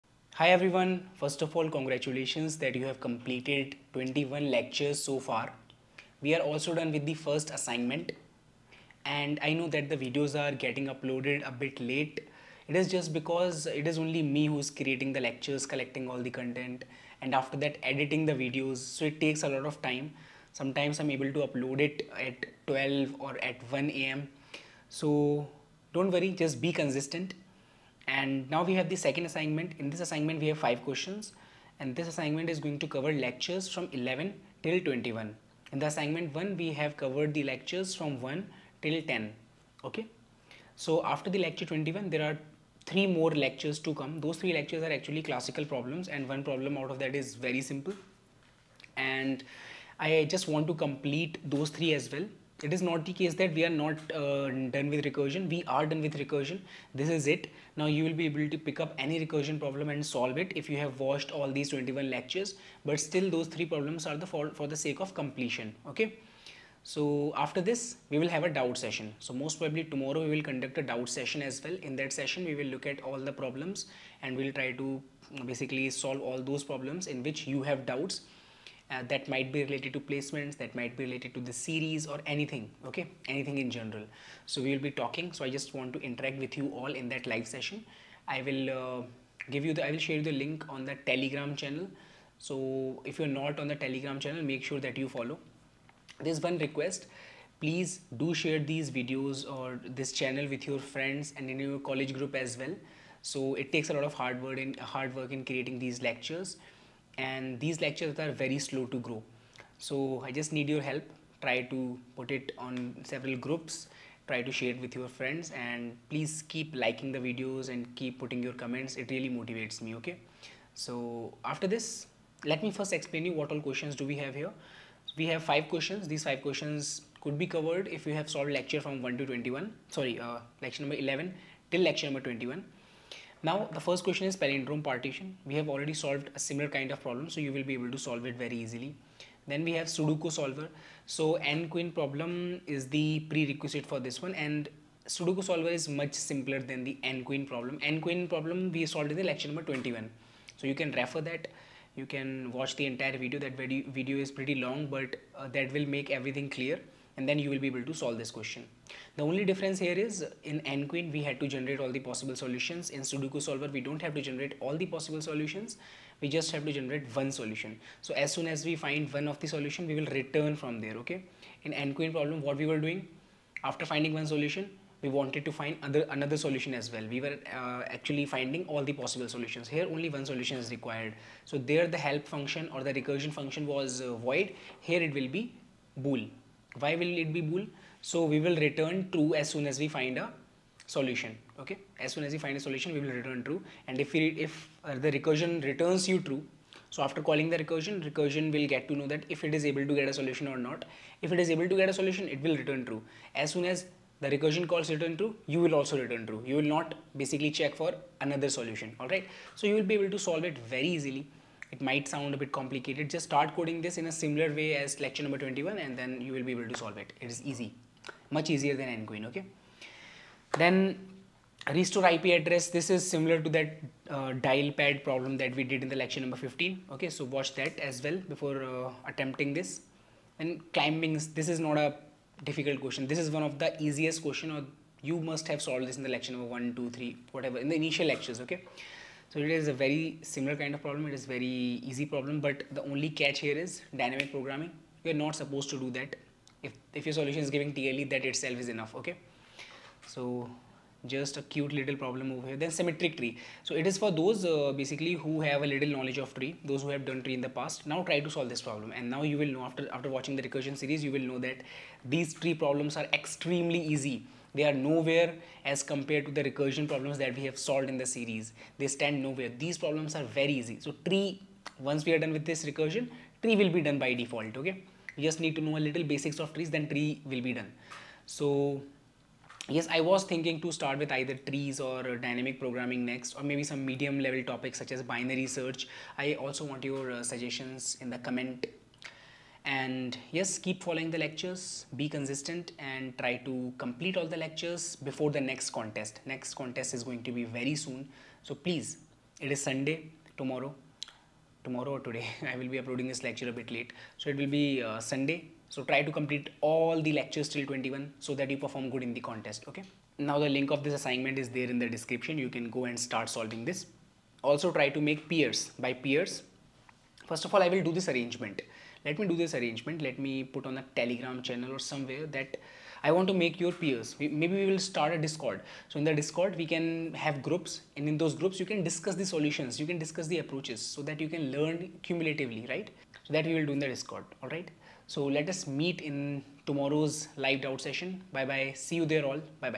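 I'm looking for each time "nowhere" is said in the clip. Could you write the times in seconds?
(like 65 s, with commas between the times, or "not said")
264 s, 269 s.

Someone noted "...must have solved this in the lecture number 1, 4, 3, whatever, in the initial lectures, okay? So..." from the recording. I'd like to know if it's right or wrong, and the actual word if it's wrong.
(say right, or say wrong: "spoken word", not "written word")
wrong: "2", not "4".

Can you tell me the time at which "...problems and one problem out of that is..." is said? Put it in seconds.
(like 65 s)
45 s.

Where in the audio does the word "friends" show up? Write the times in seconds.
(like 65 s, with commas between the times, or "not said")
100 s, 115 s.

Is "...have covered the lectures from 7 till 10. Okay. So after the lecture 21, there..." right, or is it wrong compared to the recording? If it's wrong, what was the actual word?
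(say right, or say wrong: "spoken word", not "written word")
wrong: "1", not "7".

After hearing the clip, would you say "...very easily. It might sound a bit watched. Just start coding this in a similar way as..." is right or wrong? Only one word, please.
wrong.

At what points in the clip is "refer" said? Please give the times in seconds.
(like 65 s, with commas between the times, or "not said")
150 s.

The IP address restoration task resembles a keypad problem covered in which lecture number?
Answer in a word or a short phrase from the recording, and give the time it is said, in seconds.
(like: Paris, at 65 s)
15, at 225 s.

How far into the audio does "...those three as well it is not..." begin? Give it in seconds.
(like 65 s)
51 s.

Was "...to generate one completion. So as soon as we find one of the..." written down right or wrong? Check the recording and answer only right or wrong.
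wrong.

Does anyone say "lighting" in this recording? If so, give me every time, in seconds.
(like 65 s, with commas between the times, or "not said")
not said.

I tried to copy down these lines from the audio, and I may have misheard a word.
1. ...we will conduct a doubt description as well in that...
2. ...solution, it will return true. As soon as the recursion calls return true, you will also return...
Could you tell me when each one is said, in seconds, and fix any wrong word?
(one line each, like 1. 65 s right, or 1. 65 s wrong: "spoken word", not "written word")
1. 70 s wrong: "session", not "description"
2. 201 s right.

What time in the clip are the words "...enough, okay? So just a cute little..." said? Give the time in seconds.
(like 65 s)
248 s.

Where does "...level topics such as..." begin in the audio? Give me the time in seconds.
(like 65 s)
284 s.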